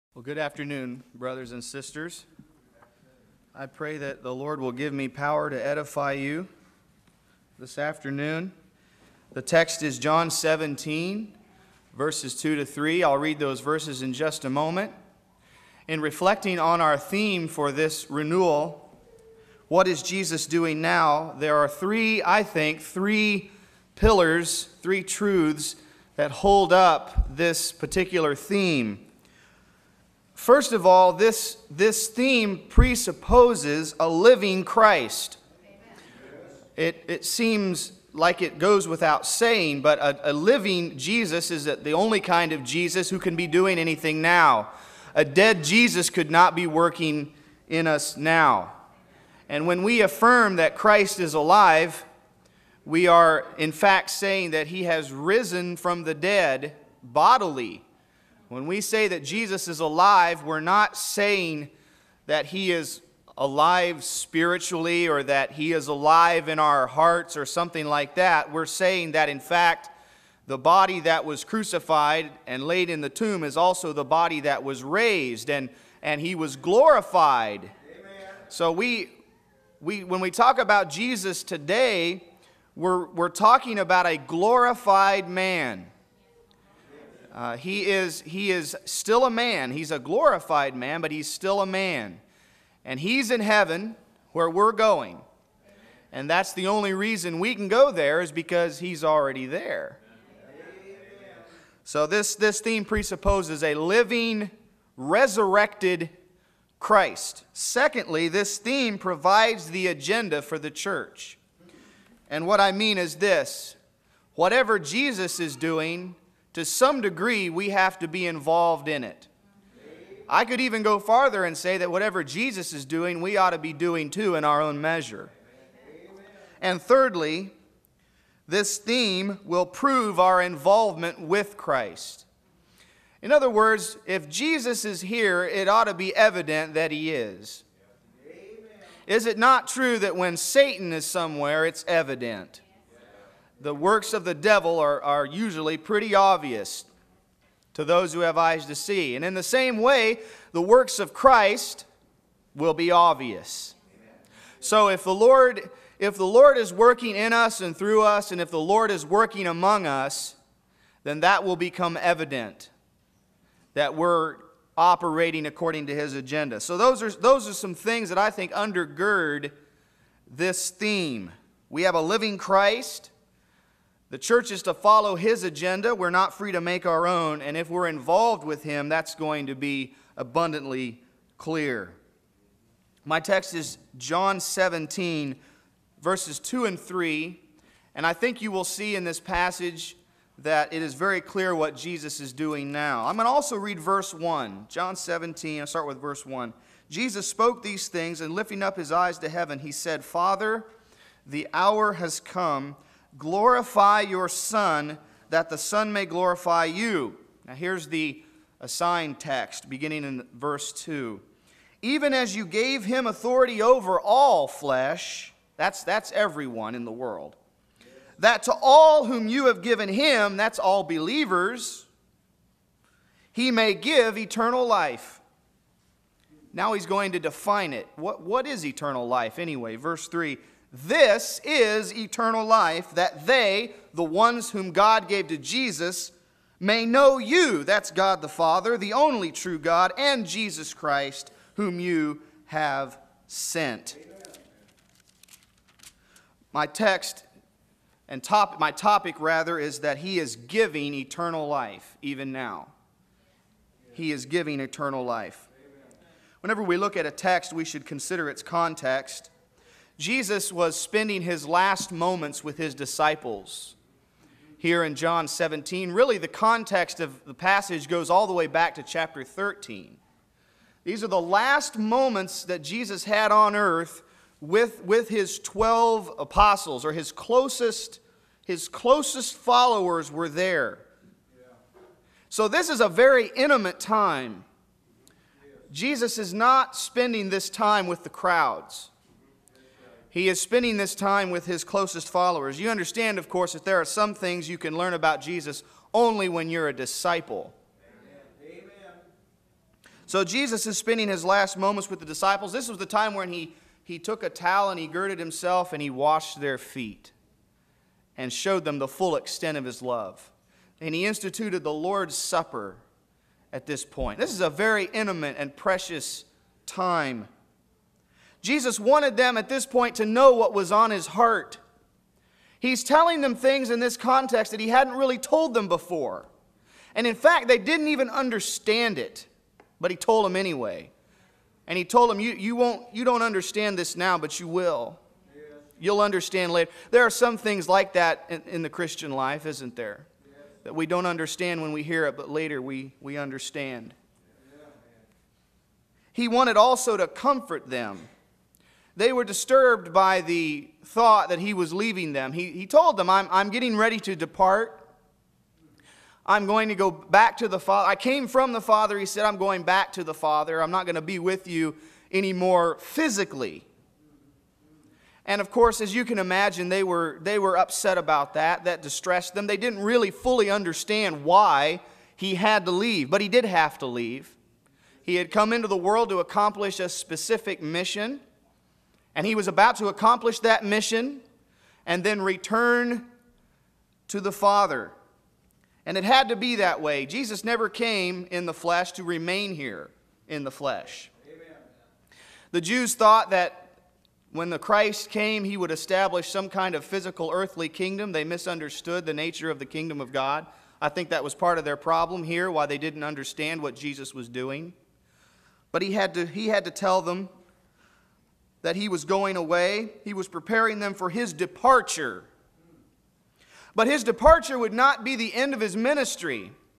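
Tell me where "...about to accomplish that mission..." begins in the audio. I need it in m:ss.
6:19.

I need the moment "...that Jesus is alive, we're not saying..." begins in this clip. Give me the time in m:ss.
0:59.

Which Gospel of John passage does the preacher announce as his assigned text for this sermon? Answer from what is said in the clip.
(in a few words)
John 17:2-3.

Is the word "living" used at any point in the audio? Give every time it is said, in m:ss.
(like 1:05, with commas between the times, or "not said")
0:34, 0:40, 1:43, 2:52.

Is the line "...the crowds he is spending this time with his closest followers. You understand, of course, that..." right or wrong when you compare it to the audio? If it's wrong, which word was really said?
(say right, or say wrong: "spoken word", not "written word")
right.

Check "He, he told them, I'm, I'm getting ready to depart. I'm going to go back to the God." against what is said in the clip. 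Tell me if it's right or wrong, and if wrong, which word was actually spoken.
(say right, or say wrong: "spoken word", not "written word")
wrong: "Father", not "God".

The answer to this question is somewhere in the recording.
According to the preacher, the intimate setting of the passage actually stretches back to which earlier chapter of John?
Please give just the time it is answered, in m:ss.
4:28.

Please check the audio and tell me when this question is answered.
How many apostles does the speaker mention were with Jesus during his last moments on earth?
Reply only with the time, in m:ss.
4:35.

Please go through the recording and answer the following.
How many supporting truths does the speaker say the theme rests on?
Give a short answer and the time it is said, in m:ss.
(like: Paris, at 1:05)
3, at 0:22.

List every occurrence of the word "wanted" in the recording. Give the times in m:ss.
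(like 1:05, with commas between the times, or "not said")
5:18, 5:46.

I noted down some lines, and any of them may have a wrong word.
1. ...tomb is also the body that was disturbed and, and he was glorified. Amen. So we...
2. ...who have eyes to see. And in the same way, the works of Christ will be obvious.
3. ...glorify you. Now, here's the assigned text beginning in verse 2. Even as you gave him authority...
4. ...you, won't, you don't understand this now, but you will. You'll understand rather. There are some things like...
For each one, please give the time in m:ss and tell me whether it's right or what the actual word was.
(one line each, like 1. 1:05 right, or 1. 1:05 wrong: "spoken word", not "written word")
1. 1:13 wrong: "raised", not "disturbed"
2. 2:28 right
3. 3:26 right
4. 5:32 wrong: "later", not "rather".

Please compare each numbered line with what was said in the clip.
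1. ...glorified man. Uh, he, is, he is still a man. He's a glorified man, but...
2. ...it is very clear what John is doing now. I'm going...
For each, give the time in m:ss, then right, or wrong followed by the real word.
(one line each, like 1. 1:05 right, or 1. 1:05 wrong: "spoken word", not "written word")
1. 1:24 right
2. 3:10 wrong: "Jesus", not "John".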